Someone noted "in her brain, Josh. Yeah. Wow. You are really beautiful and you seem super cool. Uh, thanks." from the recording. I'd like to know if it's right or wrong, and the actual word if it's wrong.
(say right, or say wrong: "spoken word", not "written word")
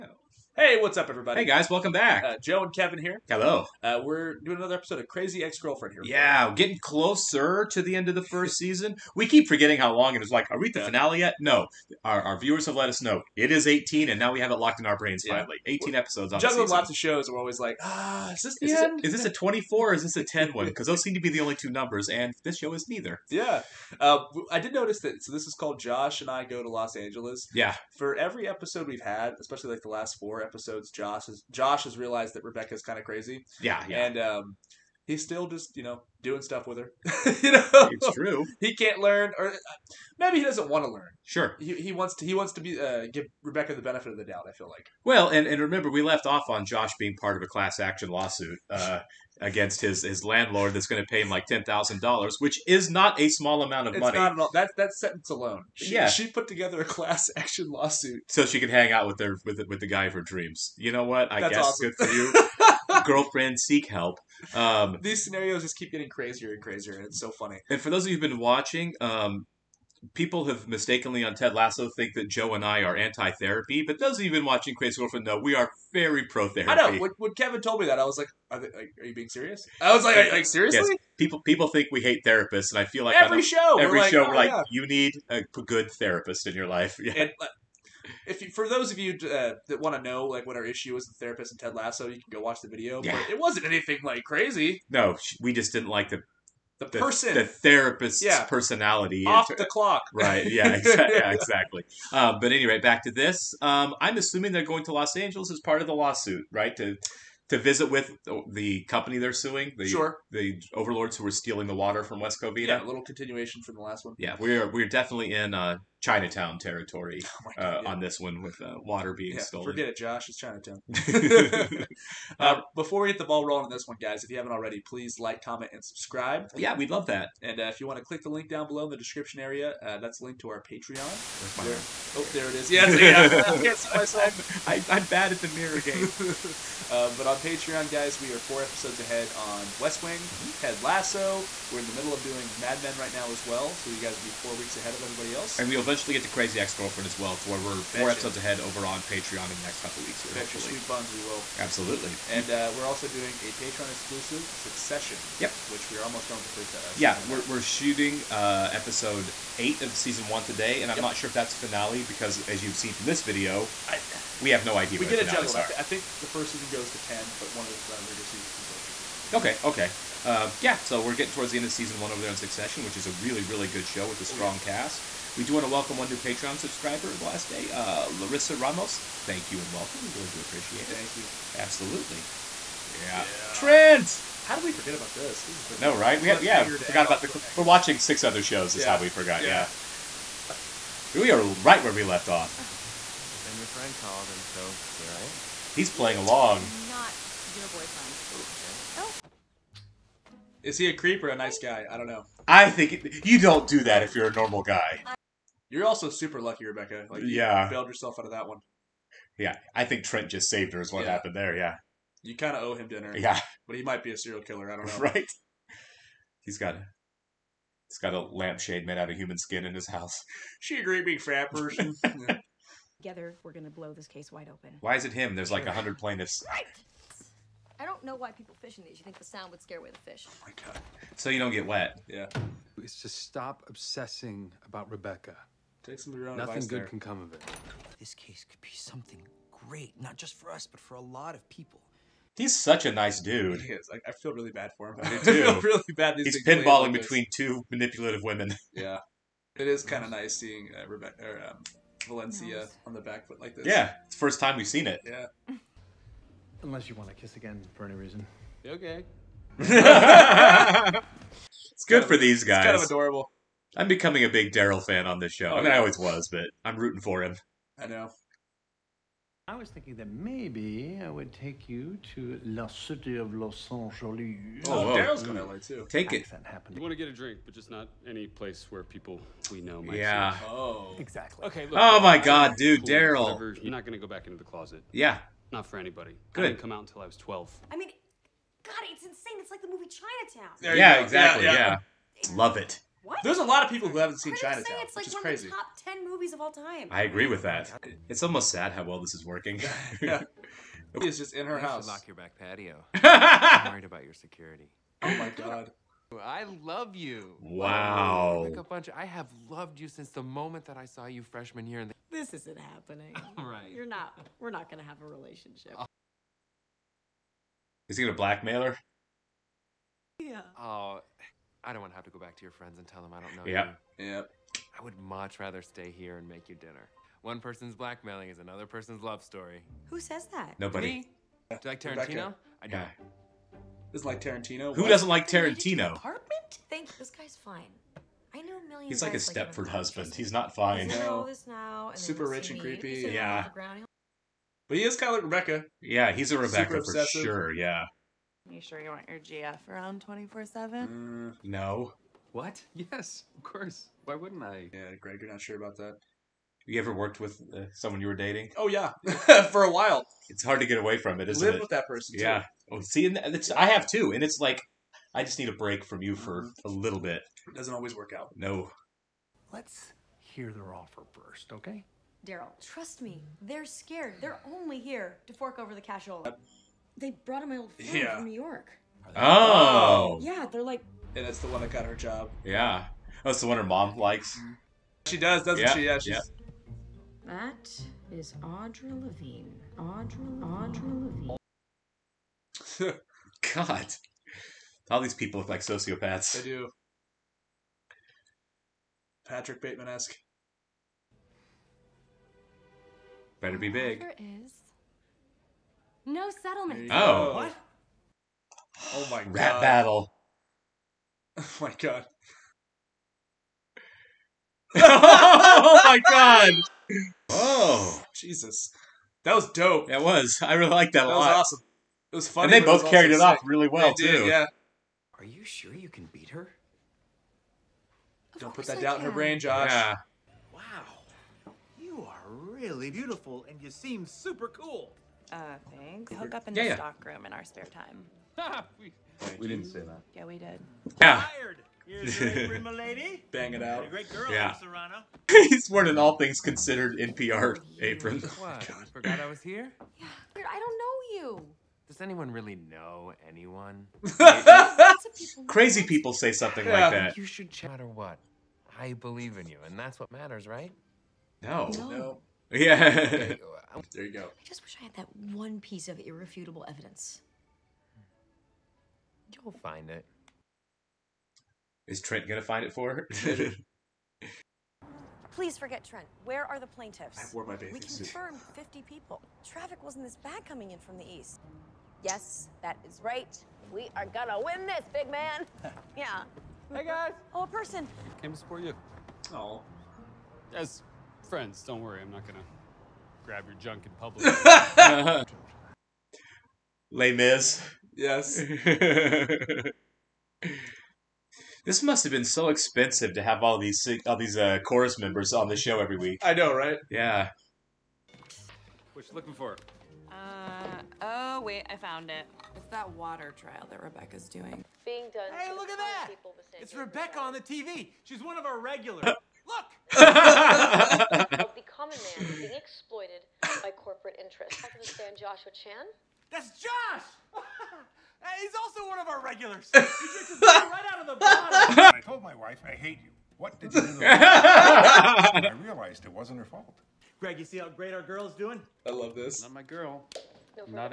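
right.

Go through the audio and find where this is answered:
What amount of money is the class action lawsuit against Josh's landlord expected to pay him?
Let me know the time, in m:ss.
0:51.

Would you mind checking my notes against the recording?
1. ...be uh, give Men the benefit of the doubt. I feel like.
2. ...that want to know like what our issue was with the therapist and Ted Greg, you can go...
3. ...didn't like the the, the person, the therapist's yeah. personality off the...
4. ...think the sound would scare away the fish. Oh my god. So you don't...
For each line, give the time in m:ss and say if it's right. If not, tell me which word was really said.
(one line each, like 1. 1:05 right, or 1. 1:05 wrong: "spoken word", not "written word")
1. 0:42 wrong: "Rebecca", not "Men"
2. 1:29 wrong: "Lasso", not "Greg"
3. 1:35 right
4. 3:49 right.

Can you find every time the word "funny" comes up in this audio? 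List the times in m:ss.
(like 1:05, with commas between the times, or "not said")
1:07, 7:02.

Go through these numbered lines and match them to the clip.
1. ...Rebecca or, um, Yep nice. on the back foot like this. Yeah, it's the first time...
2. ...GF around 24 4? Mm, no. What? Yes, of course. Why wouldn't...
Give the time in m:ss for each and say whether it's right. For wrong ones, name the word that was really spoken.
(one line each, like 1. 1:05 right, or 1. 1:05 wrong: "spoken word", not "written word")
1. 4:10 wrong: "Valencia", not "Yep"
2. 5:49 wrong: "7", not "4".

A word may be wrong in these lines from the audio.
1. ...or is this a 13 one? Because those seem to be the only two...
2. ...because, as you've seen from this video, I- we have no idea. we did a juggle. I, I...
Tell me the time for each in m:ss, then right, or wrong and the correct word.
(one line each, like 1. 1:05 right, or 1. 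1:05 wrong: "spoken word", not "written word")
1. 0:19 wrong: "10", not "13"
2. 2:42 right.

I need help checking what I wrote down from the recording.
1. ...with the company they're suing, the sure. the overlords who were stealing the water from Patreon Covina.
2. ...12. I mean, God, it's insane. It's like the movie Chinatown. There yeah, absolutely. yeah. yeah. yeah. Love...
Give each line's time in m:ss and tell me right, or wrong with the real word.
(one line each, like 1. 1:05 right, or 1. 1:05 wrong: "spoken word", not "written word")
1. 1:47 wrong: "West", not "Patreon"
2. 4:47 wrong: "exactly", not "absolutely".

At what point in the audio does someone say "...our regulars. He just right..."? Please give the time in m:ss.
8:49.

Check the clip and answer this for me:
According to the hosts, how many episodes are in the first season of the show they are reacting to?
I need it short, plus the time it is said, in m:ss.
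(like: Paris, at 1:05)
18, at 0:15.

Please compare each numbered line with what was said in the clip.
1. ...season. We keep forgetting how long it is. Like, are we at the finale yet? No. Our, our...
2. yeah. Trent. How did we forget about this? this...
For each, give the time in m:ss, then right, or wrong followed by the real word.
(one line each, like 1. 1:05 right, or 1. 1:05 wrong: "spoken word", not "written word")
1. 0:08 right
2. 3:03 right.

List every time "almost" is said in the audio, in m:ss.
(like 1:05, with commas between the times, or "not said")
2:36, 4:58.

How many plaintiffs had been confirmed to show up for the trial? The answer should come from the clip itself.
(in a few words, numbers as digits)
50.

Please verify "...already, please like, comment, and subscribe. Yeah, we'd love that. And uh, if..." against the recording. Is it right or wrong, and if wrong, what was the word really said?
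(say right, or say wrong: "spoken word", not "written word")
right.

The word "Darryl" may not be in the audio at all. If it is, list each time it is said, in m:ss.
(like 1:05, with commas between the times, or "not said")
4:24, 4:34, 4:42, 6:12.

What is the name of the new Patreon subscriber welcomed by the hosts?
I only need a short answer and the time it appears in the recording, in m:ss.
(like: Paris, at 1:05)
Larissa Ramos, at 2:58.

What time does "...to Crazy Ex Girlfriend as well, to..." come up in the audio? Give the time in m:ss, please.
2:26.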